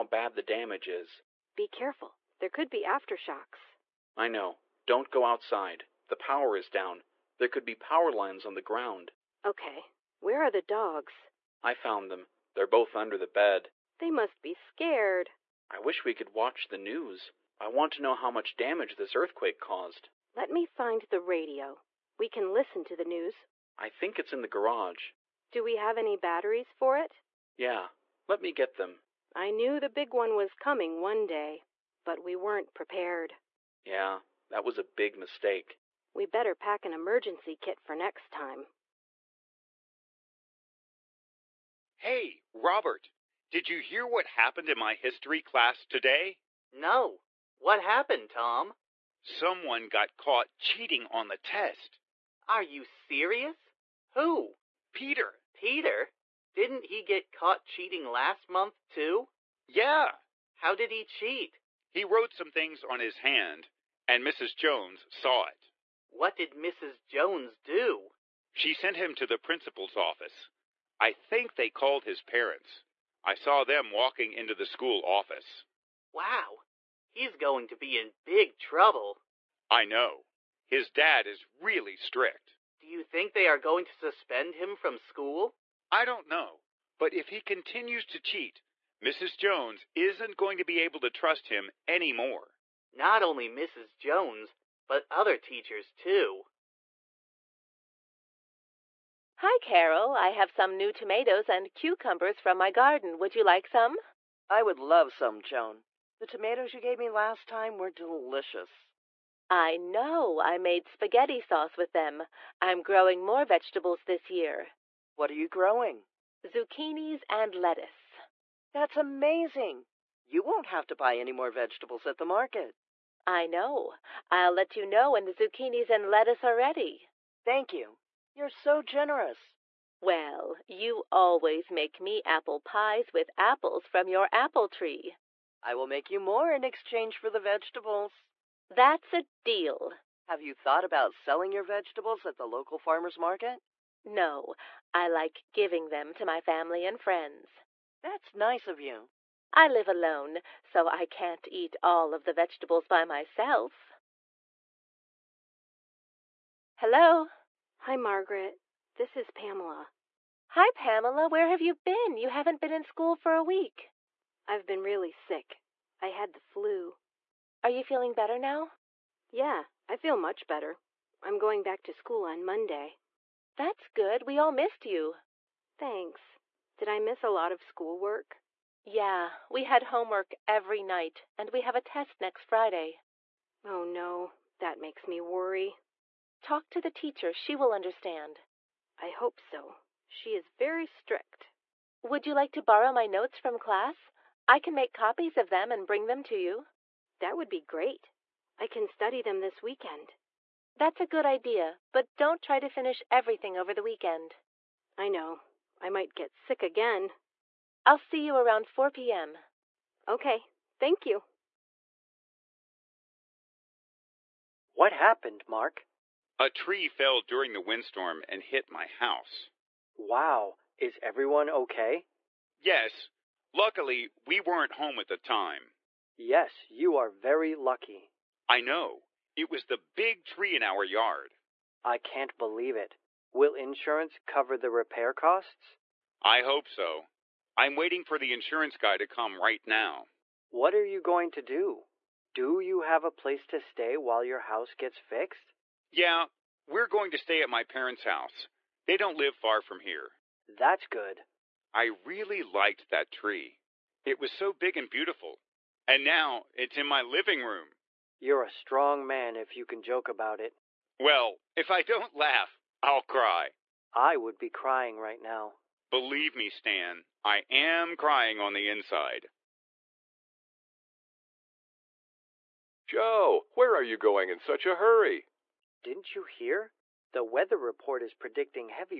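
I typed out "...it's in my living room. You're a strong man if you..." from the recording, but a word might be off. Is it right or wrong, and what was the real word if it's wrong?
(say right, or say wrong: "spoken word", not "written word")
right.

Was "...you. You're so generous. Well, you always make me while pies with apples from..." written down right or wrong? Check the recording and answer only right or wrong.
wrong.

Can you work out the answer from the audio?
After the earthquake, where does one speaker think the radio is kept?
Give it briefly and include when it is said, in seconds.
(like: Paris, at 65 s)
the garage, at 24 s.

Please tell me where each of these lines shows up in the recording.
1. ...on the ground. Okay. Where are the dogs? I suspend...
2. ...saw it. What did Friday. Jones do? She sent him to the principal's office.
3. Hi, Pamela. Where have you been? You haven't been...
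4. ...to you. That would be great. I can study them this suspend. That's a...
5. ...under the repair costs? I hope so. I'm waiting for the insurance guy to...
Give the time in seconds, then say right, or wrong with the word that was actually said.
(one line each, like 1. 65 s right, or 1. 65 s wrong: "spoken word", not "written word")
1. 8 s wrong: "found", not "suspend"
2. 65 s wrong: "Mrs", not "Friday"
3. 160 s right
4. 196 s wrong: "weekend", not "suspend"
5. 234 s wrong: "cover", not "under".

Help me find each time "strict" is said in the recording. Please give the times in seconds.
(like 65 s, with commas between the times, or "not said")
81 s, 190 s.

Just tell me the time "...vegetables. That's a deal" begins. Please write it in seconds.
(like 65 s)
137 s.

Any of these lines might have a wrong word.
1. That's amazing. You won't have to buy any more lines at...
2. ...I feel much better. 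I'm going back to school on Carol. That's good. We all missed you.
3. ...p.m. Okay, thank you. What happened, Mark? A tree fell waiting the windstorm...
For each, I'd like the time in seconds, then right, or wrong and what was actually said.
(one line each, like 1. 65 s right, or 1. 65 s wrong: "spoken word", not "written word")
1. 118 s wrong: "vegetables", not "lines"
2. 169 s wrong: "Monday", not "Carol"
3. 208 s wrong: "during", not "waiting".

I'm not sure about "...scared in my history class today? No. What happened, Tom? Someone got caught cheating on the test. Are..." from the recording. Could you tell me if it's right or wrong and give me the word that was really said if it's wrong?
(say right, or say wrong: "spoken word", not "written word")
wrong: "happened", not "scared".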